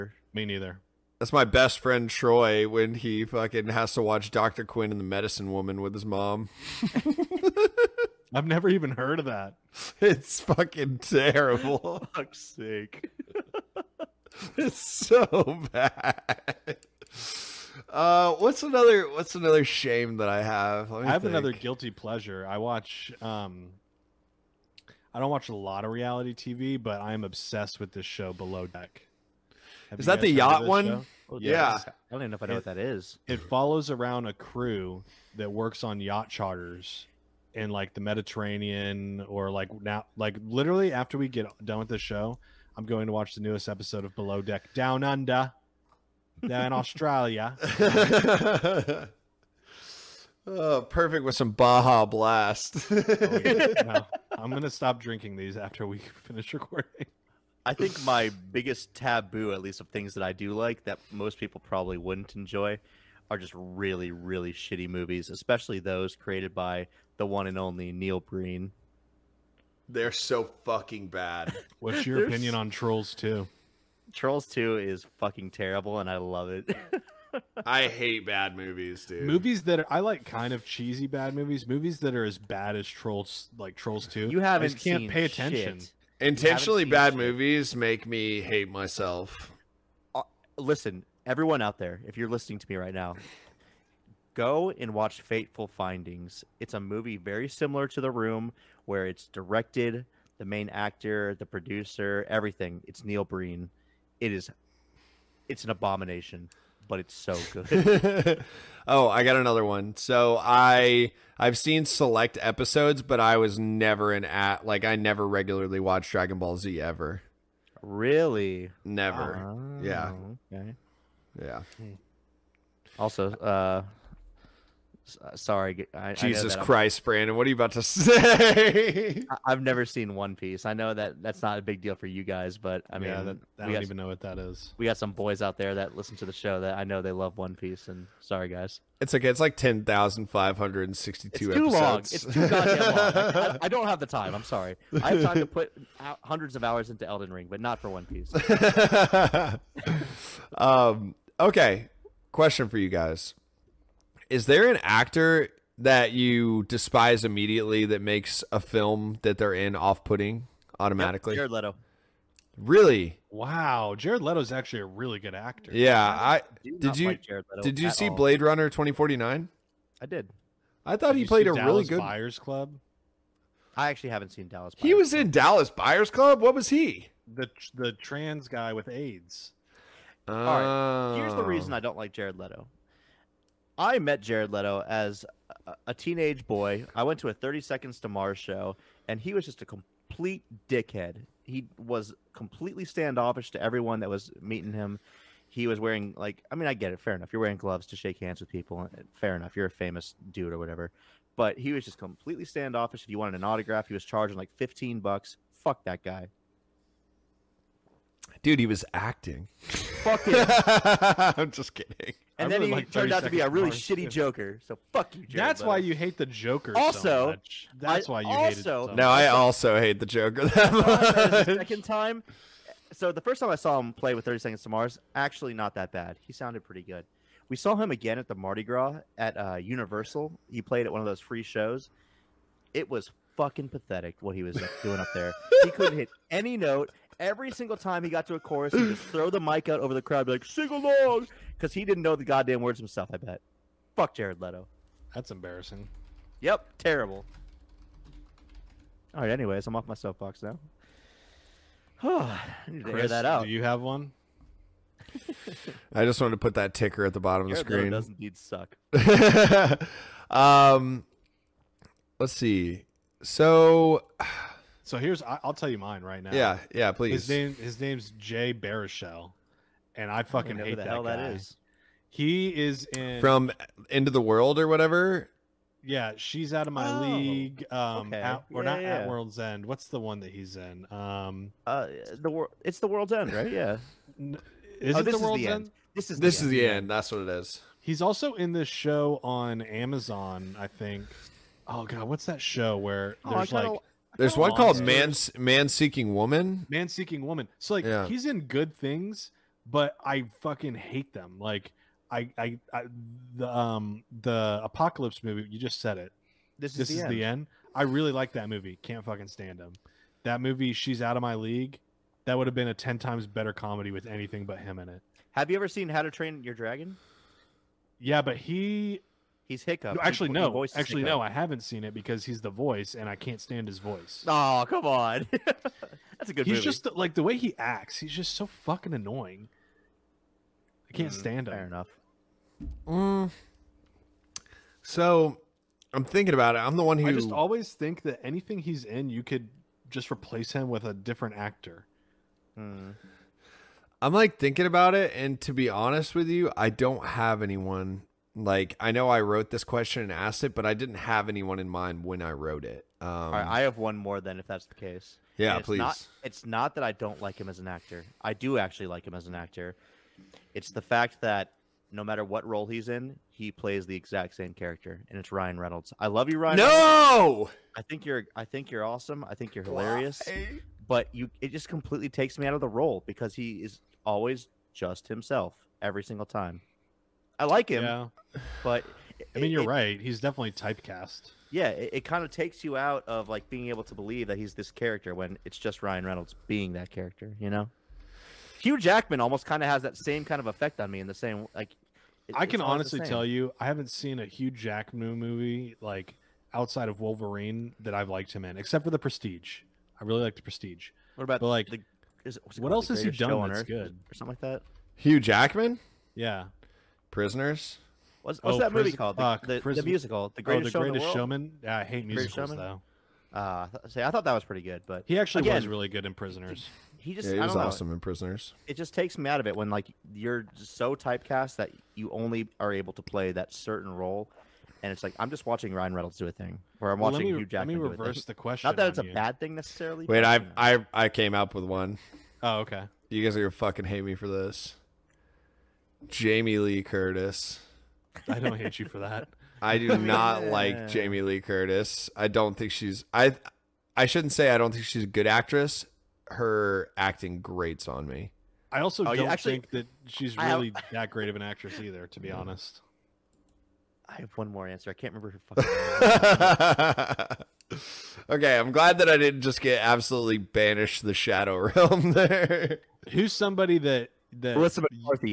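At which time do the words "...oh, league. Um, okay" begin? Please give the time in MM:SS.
04:36.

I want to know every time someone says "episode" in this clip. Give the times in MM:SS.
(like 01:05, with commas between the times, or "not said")
00:43, 01:52.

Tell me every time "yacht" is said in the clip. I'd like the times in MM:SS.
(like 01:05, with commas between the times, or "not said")
00:30, 00:36.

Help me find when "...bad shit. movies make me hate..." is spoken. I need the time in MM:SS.
01:26.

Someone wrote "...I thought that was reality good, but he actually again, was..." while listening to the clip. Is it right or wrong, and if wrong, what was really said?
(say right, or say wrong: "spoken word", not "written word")
wrong: "pretty", not "reality".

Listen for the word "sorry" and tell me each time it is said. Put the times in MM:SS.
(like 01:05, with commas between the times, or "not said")
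02:05, 02:18, 02:24.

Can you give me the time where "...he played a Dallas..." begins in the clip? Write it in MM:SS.
02:51.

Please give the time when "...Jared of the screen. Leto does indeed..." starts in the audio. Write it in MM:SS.
04:17.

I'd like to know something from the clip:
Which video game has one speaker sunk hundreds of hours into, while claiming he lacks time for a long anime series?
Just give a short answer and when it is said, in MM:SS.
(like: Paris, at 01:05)
Elden Ring, at 02:27.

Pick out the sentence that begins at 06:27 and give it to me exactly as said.
You know, Hugh Jackman almost kind of has that same kind of effect on me in the same like.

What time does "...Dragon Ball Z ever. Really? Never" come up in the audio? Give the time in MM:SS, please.
01:56.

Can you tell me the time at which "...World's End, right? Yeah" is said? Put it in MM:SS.
04:42.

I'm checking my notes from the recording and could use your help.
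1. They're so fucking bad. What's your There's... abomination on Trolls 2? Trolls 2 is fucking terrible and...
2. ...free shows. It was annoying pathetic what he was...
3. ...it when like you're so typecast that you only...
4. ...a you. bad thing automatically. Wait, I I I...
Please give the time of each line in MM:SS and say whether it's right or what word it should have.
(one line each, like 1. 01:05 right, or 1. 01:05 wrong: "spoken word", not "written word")
1. 01:09 wrong: "opinion", not "abomination"
2. 03:51 wrong: "fucking", not "annoying"
3. 06:59 right
4. 07:08 wrong: "necessarily", not "automatically".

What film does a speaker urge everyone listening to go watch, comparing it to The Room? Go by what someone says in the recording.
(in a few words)
Fateful Findings.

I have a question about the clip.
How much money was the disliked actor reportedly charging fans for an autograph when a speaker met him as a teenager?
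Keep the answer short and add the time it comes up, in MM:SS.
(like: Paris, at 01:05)
$15, at 03:24.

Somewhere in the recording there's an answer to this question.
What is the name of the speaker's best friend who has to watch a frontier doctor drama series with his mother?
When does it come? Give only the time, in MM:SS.
00:02.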